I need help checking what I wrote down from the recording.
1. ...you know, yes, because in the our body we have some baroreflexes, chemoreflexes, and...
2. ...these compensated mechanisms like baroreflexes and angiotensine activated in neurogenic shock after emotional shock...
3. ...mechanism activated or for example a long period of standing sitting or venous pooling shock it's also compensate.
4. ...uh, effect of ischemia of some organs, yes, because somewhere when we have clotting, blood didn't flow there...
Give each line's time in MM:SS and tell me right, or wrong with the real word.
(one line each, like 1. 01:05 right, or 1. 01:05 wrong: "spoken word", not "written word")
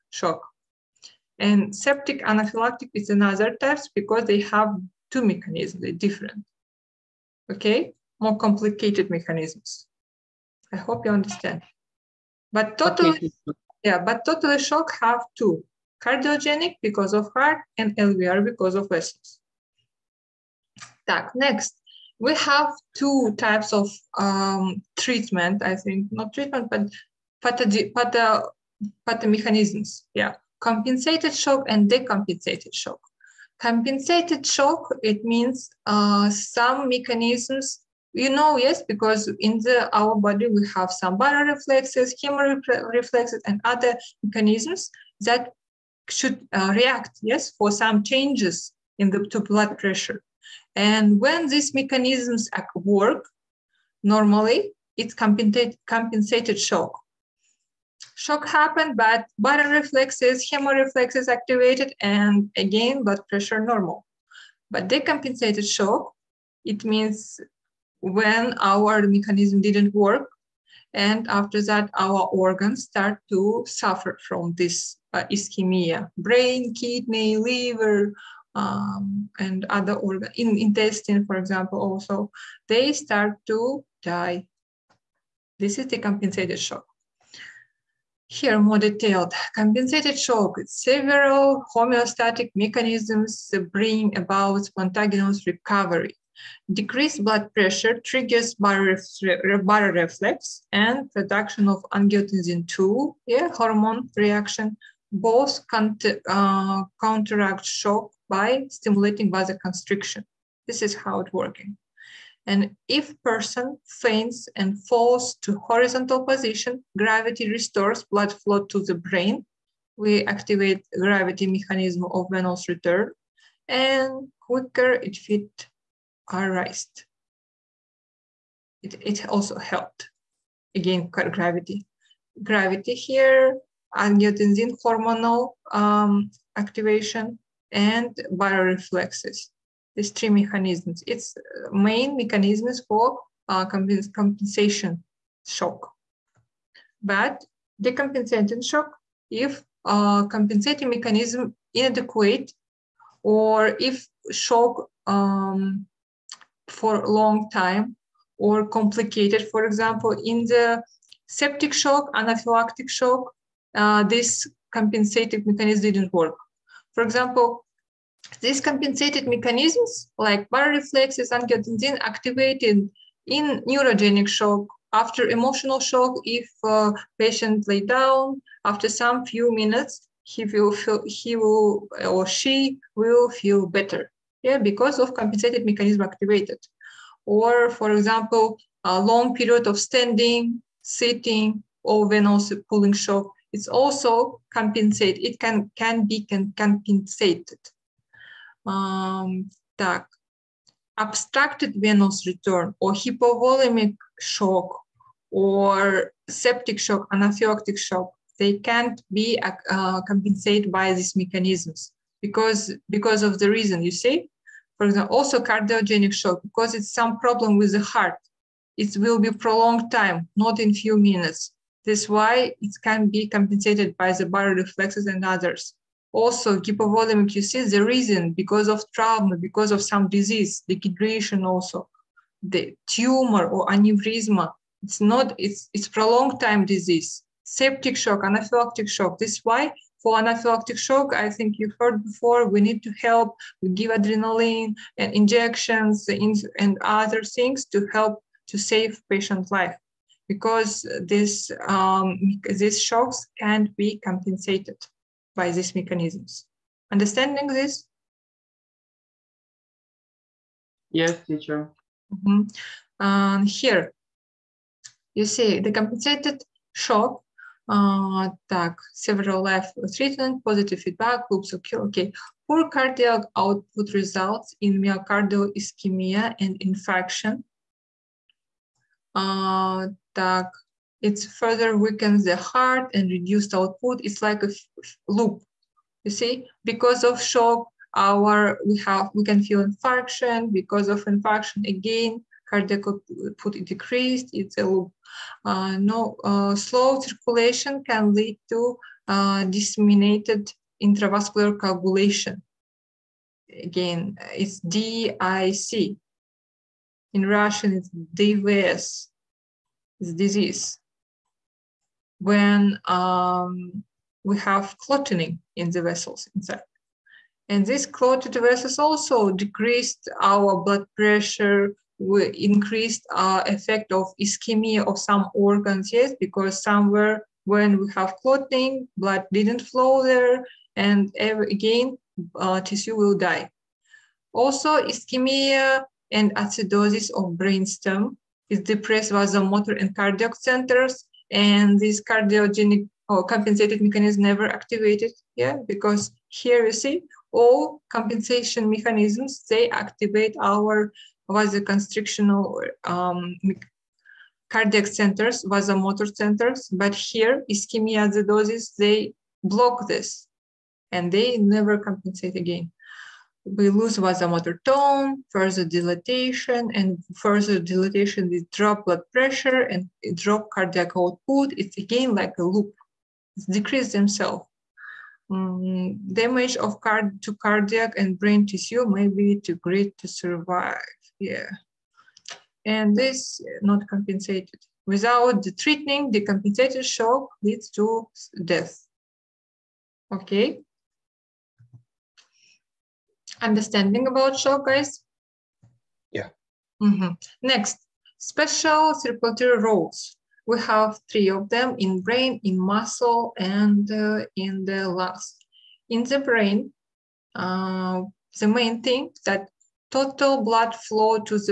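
1. 00:38 right
2. 02:48 right
3. 03:05 right
4. 05:23 right.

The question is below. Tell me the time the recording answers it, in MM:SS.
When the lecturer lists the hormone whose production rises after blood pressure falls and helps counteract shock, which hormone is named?
01:41.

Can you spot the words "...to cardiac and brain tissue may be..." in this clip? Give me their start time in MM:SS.
06:17.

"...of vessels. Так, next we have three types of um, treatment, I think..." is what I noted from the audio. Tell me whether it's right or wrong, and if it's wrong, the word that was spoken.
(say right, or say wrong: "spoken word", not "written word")
wrong: "two", not "three".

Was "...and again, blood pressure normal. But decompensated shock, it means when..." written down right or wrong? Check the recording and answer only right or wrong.
right.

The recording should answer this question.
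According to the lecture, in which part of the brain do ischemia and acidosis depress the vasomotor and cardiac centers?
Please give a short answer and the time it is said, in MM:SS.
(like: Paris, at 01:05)
brainstem, at 05:37.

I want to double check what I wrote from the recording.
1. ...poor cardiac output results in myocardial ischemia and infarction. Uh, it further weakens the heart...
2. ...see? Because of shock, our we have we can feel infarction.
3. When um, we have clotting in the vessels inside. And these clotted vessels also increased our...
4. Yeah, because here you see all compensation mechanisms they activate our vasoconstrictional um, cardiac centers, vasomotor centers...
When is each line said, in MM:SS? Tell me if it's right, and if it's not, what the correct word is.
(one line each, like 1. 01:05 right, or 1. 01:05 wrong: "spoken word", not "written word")
1. 04:32 right
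2. 04:46 right
3. 05:12 wrong: "decreased", not "increased"
4. 05:45 right.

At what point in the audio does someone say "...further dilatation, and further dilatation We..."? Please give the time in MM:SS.
06:05.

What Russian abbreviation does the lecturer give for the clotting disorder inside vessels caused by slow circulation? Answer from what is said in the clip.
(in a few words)
DVS.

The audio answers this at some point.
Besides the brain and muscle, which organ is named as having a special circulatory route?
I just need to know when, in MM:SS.
06:44.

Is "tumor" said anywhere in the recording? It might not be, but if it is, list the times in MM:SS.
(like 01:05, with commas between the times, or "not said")
03:52.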